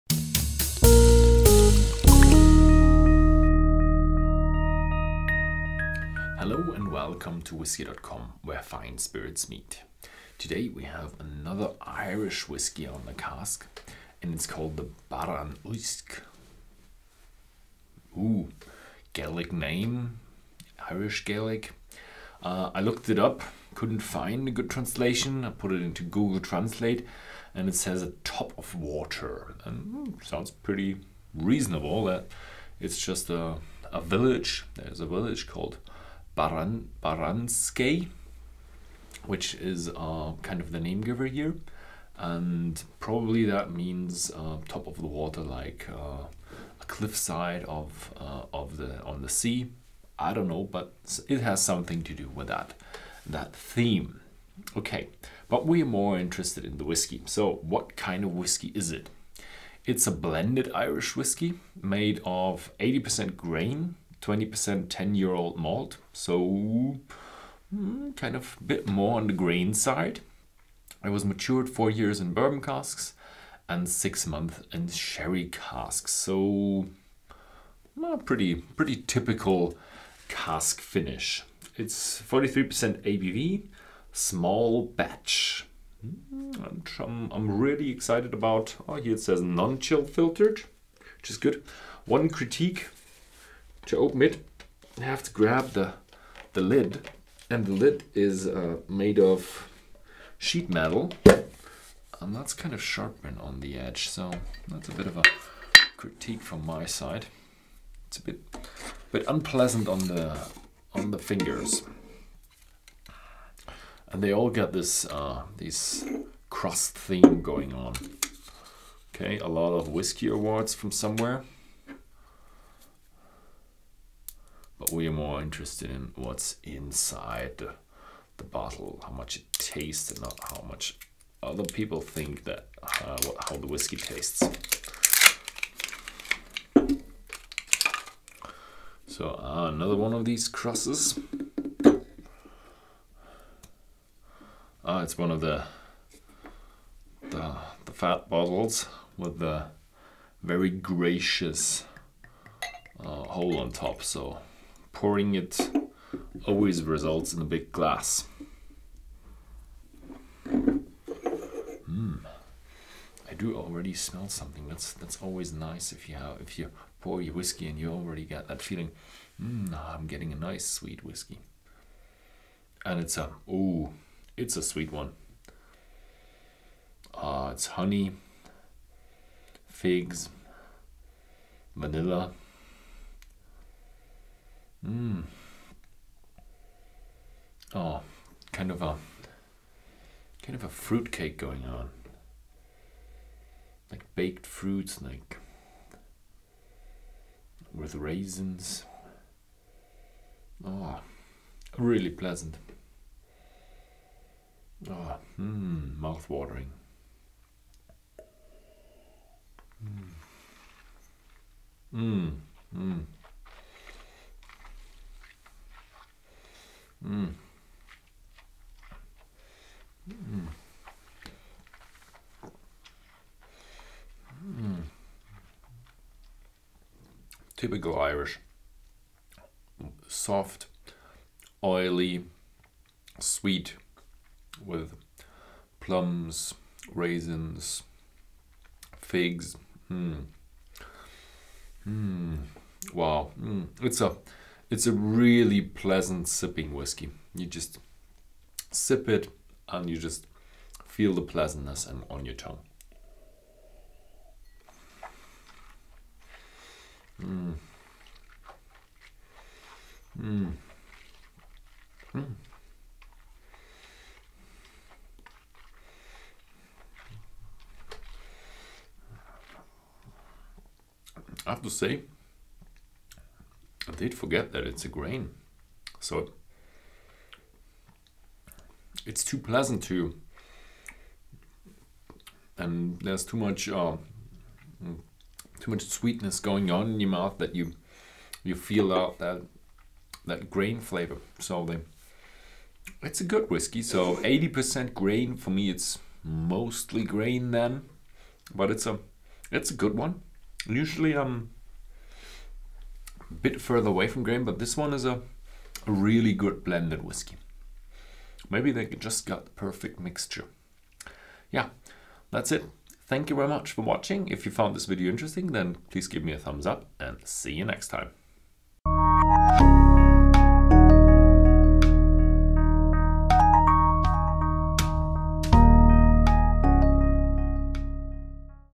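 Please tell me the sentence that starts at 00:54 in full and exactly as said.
Okay, but we're more interested in the whiskey.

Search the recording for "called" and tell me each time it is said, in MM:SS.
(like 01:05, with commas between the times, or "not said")
00:14, 00:35.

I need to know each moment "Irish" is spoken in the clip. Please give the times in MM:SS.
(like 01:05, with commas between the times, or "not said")
00:11, 00:20, 01:00, 03:47.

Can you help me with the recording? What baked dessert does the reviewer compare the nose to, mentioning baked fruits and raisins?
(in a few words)
fruit cake.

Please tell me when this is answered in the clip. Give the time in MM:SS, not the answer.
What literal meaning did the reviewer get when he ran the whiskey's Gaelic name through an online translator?
00:28.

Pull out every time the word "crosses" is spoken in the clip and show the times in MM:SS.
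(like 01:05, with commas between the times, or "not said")
02:20.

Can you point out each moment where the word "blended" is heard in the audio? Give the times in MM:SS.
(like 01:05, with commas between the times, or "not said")
01:00, 05:06.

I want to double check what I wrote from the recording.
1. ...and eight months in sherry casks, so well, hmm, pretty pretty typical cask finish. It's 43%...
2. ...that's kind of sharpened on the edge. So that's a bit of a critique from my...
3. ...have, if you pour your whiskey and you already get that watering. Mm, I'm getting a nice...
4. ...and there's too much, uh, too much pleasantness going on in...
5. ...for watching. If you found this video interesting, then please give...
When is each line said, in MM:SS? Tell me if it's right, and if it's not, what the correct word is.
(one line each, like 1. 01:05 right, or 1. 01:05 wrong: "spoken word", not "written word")
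1. 01:13 wrong: "six", not "eight"
2. 01:42 right
3. 02:46 wrong: "feeling", not "watering"
4. 04:42 wrong: "sweetness", not "pleasantness"
5. 05:13 right.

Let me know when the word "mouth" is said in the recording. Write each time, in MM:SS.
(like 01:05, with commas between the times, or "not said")
03:26, 04:47.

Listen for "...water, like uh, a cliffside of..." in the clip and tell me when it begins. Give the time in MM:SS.
00:45.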